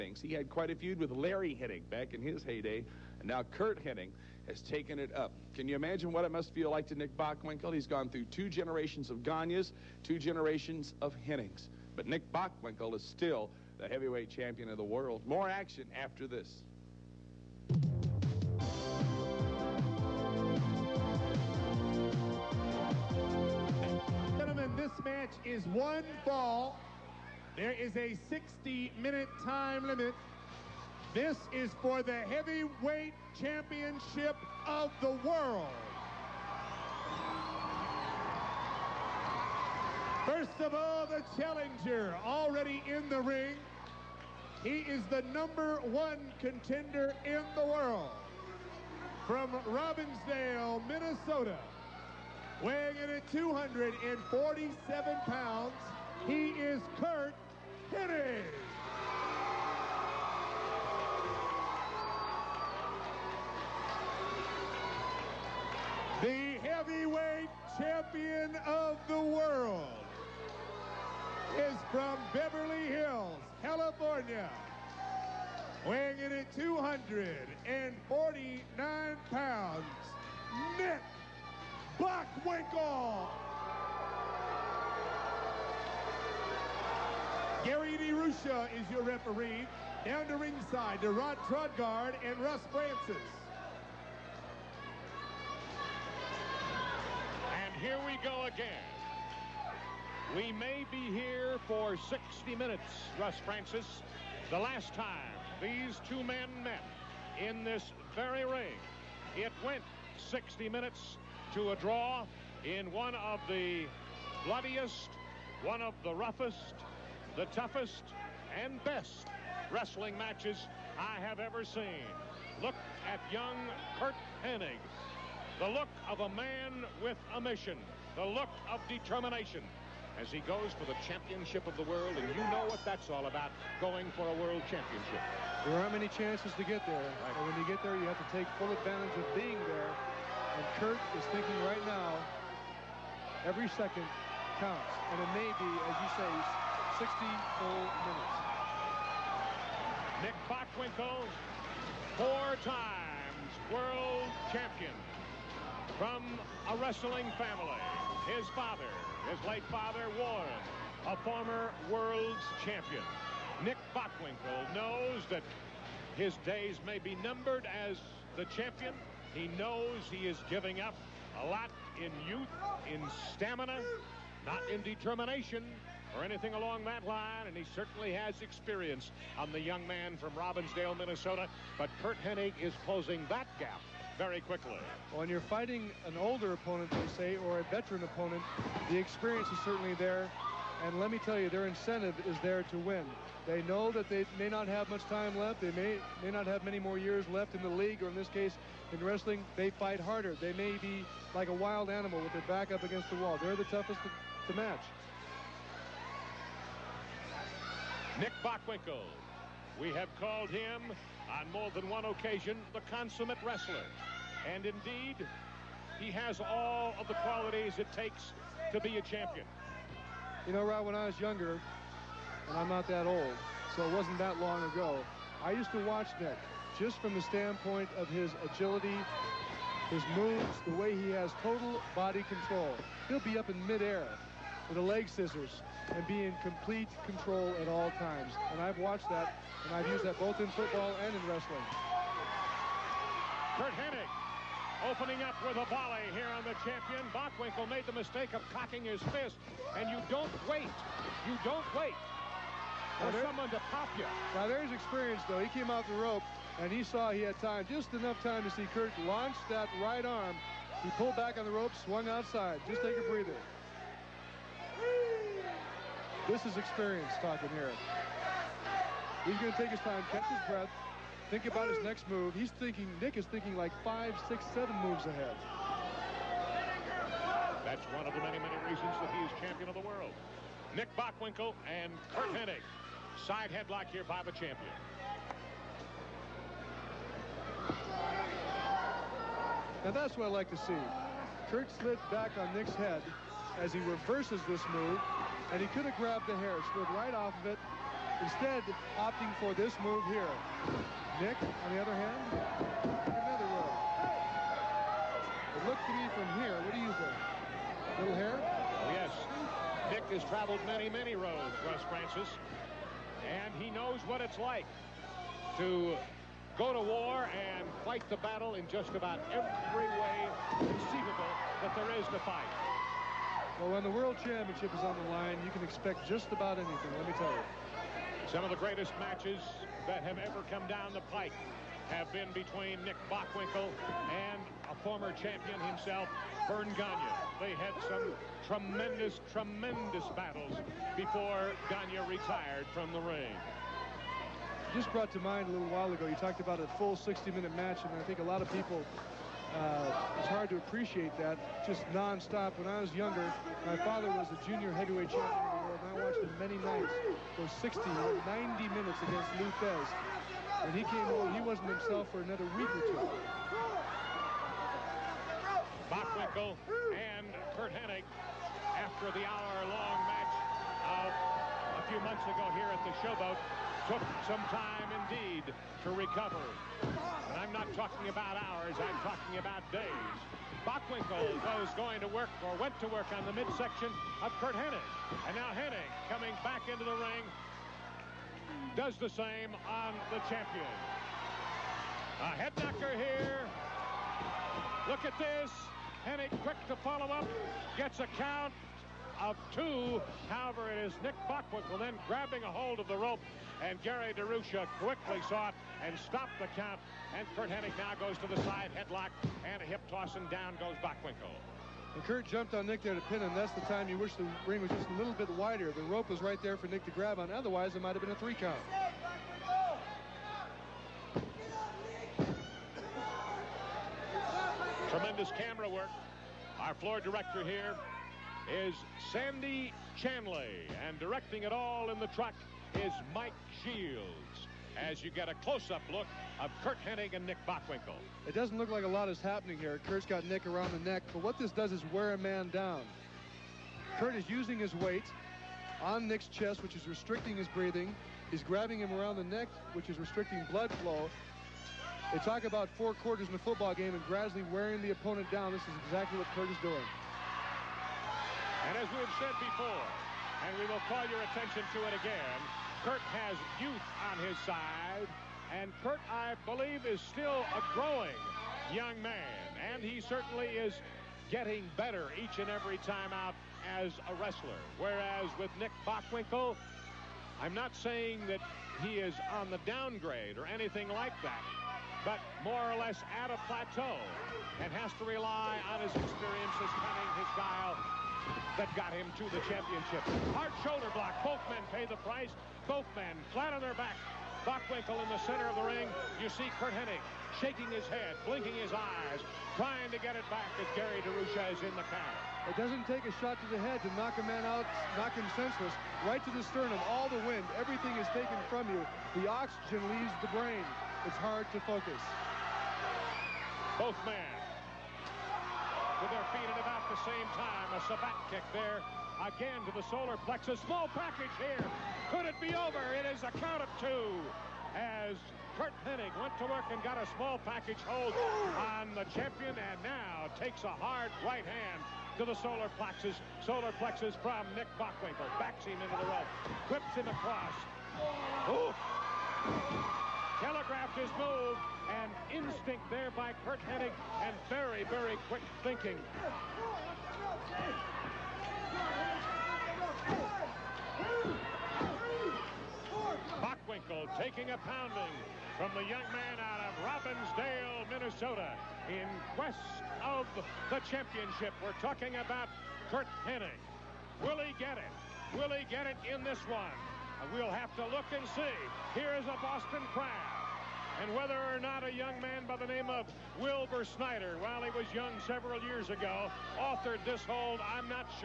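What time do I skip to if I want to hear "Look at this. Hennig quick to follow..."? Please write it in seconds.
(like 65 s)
394 s.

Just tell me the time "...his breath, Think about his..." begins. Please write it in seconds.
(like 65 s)
270 s.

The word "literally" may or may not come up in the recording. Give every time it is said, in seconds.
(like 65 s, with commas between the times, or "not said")
not said.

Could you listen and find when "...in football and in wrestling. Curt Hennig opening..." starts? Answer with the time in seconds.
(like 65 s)
240 s.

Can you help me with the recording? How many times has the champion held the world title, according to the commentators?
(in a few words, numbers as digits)
4.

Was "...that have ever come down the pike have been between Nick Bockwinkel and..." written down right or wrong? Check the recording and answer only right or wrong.
right.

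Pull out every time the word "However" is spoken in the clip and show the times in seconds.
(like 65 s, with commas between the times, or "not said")
400 s.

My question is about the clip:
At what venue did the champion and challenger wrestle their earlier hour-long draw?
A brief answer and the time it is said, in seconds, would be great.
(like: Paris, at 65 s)
the Showboat, at 372 s.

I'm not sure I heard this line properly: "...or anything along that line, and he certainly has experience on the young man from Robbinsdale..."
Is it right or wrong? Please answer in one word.
right.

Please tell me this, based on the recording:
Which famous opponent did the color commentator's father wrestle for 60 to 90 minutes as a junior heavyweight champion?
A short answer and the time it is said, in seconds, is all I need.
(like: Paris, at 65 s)
Lou Thesz, at 359 s.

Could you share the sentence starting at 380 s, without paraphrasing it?
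Bockwinkel was going to work or went to work on the midsection of Curt Hennig.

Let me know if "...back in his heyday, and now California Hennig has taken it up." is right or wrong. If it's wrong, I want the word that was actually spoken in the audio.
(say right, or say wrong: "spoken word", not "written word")
wrong: "Curt", not "California".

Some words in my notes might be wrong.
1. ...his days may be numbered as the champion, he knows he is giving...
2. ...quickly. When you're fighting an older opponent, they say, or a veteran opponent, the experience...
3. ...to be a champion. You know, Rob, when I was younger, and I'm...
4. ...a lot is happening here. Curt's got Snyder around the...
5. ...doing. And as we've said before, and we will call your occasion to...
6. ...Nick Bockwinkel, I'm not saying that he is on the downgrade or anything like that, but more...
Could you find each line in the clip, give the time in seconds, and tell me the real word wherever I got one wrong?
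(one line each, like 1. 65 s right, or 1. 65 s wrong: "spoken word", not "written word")
1. 166 s right
2. 184 s right
3. 218 s right
4. 438 s wrong: "Nick", not "Snyder"
5. 456 s wrong: "attention", not "occasion"
6. 475 s right.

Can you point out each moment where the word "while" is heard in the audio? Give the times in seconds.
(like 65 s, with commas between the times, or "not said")
345 s, 574 s.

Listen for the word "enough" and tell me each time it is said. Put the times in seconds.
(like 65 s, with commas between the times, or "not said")
257 s.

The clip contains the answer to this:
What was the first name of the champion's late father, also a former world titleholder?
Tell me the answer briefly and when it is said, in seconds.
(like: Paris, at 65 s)
Warren, at 160 s.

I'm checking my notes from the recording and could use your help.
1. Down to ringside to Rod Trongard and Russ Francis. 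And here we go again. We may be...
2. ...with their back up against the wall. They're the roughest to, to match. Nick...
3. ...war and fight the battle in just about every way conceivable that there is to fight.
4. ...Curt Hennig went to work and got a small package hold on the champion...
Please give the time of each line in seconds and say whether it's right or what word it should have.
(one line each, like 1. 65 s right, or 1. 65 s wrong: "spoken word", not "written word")
1. 90 s right
2. 202 s wrong: "toughest", not "roughest"
3. 316 s right
4. 525 s right.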